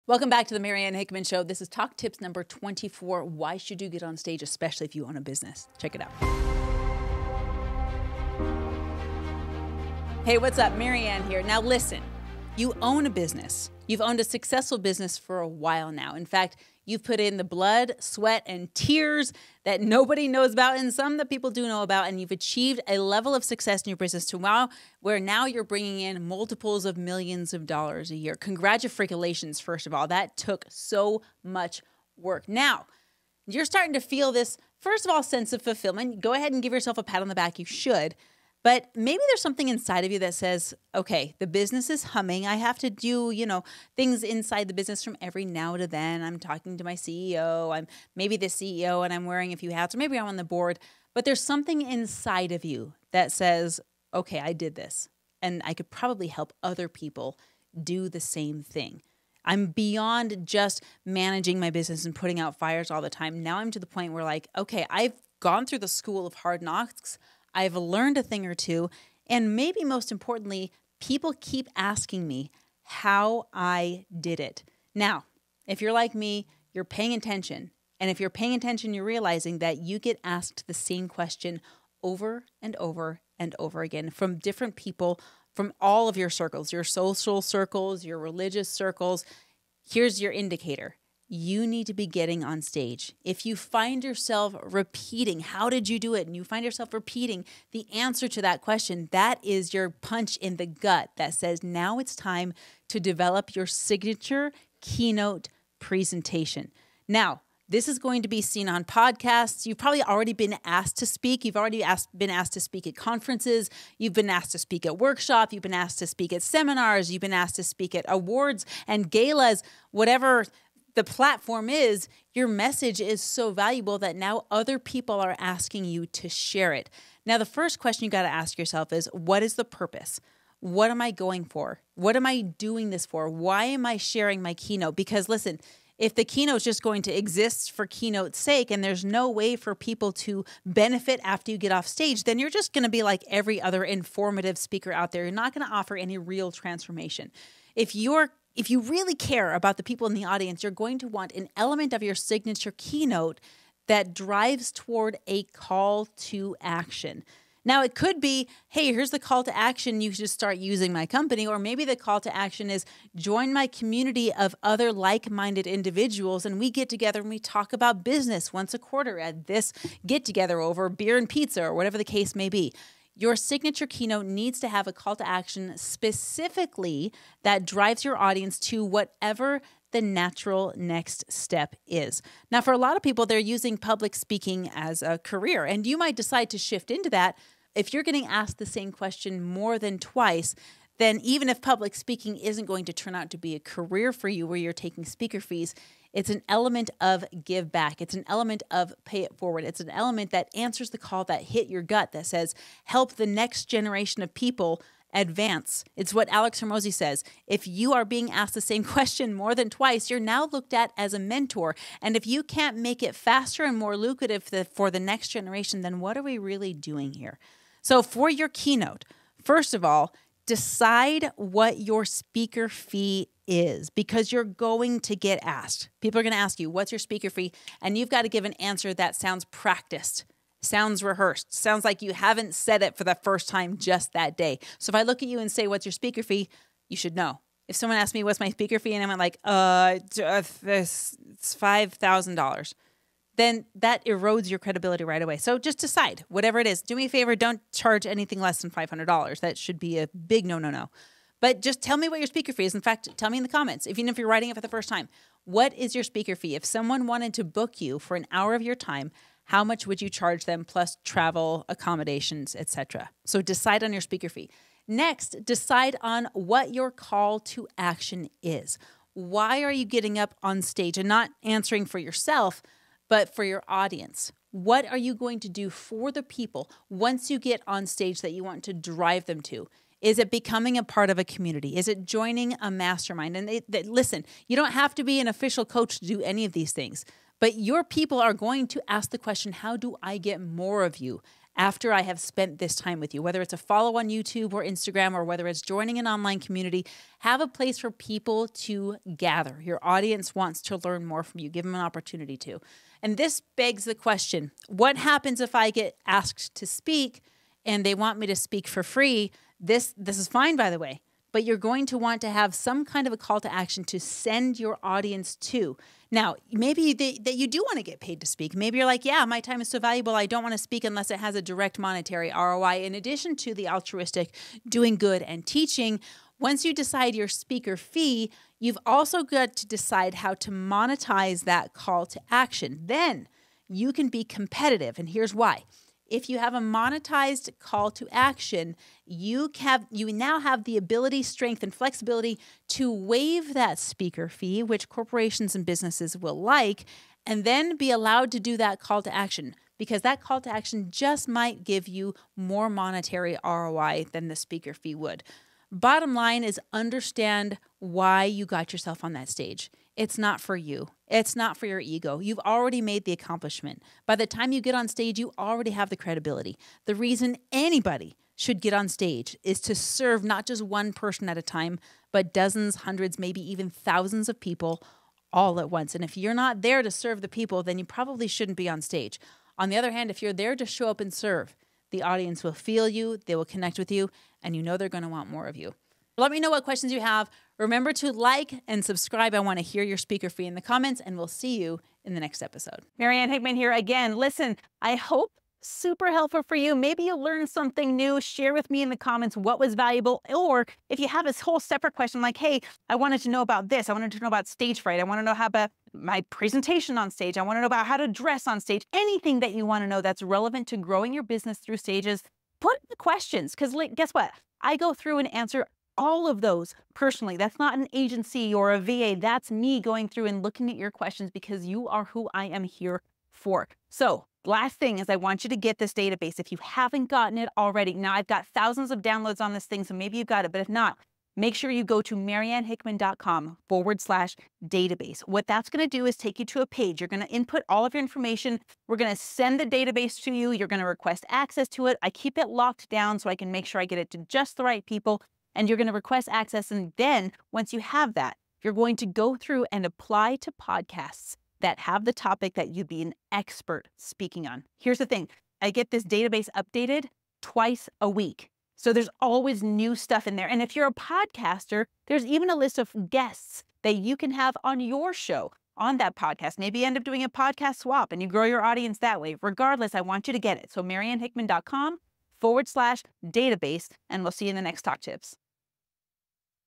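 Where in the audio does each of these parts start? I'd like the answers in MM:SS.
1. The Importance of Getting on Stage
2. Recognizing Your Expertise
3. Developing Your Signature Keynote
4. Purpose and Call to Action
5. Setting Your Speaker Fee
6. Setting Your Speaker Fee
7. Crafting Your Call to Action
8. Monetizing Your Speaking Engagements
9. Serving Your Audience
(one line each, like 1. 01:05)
1. 00:10
2. 00:38
3. 01:39
4. 02:07
5. 03:37
6. 04:11
7. 04:24
8. 05:22
9. 05:55.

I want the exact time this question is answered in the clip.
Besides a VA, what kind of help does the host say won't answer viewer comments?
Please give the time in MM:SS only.
06:57.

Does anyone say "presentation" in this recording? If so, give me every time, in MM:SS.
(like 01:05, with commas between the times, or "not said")
01:45, 06:46.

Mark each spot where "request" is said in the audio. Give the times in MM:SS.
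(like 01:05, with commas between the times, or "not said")
07:20, 07:25.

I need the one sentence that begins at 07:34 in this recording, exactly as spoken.
Here's the thing I get this database updated twice a week.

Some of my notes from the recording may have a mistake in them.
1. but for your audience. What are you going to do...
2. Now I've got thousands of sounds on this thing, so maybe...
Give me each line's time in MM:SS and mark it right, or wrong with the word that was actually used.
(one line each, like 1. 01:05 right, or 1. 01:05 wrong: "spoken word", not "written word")
1. 04:33 right
2. 07:07 wrong: "downloads", not "sounds".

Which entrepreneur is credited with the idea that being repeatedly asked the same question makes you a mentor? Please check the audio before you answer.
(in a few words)
Alex Hormozi.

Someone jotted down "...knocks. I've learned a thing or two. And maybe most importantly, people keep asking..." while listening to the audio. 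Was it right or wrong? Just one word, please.
right.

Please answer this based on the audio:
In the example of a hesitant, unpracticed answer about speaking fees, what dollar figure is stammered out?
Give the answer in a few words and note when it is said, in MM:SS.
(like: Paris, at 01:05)
$5,000, at 04:01.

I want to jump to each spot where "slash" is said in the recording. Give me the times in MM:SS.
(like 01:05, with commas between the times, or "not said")
07:14, 07:52.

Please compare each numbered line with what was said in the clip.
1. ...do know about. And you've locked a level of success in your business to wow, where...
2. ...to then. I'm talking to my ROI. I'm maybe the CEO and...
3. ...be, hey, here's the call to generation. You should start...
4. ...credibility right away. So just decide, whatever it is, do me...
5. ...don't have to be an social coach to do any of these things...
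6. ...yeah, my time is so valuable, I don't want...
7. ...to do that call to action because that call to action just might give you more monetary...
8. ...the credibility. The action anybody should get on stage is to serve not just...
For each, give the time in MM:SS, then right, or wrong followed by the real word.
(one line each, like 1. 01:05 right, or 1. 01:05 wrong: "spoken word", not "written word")
1. 00:21 wrong: "achieved", not "locked"
2. 00:45 wrong: "CEO", not "ROI"
3. 02:38 wrong: "action", not "generation"
4. 04:04 right
5. 04:44 wrong: "official", not "social"
6. 05:19 right
7. 05:48 right
8. 06:05 wrong: "reason", not "action".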